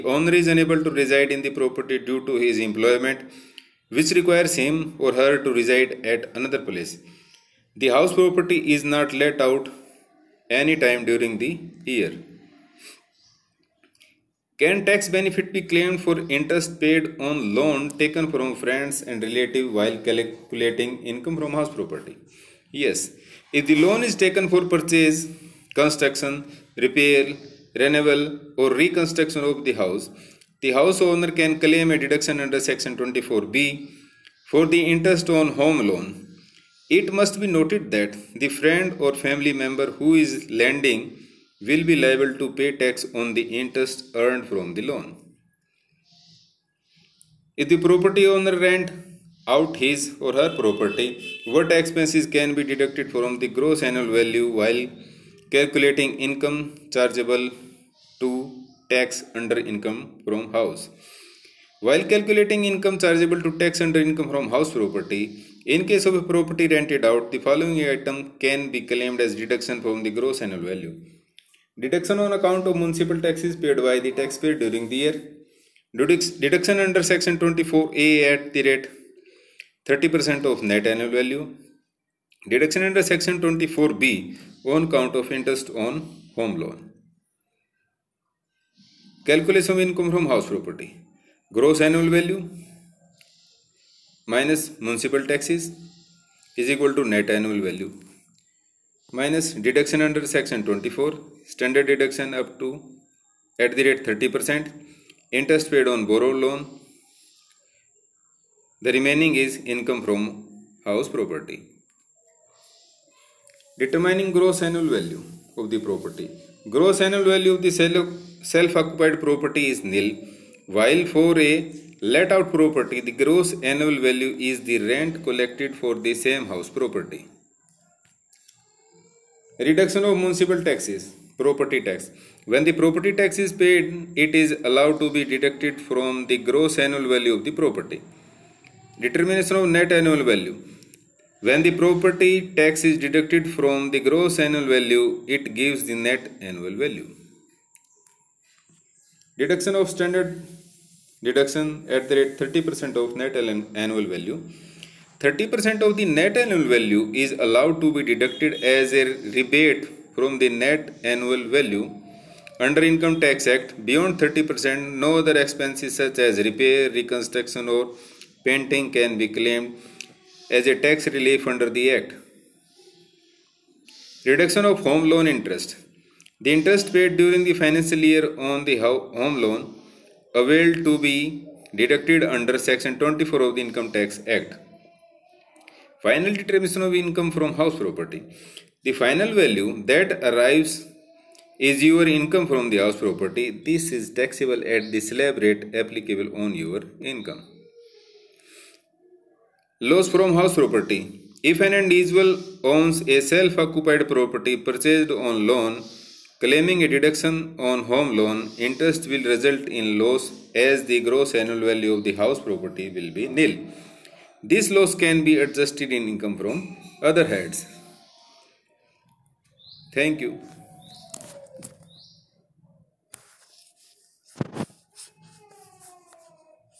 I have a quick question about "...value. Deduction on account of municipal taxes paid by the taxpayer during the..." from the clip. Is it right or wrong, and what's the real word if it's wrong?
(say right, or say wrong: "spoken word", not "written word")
right.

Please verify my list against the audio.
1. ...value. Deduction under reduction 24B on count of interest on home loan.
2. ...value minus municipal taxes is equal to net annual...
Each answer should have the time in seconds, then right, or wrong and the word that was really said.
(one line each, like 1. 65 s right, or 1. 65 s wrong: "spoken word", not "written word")
1. 81 s wrong: "section", not "reduction"
2. 92 s right.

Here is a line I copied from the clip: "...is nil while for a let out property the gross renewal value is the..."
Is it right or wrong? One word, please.
wrong.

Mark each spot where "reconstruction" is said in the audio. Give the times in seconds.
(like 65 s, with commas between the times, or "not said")
28 s, 166 s.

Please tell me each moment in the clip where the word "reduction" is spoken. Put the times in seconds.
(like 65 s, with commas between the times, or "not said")
129 s, 174 s.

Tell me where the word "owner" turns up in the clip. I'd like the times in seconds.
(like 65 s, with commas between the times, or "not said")
0 s, 31 s, 48 s.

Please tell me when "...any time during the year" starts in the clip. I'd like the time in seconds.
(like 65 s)
10 s.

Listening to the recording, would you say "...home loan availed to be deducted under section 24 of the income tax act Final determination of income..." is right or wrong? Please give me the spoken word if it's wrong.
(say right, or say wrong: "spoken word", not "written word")
right.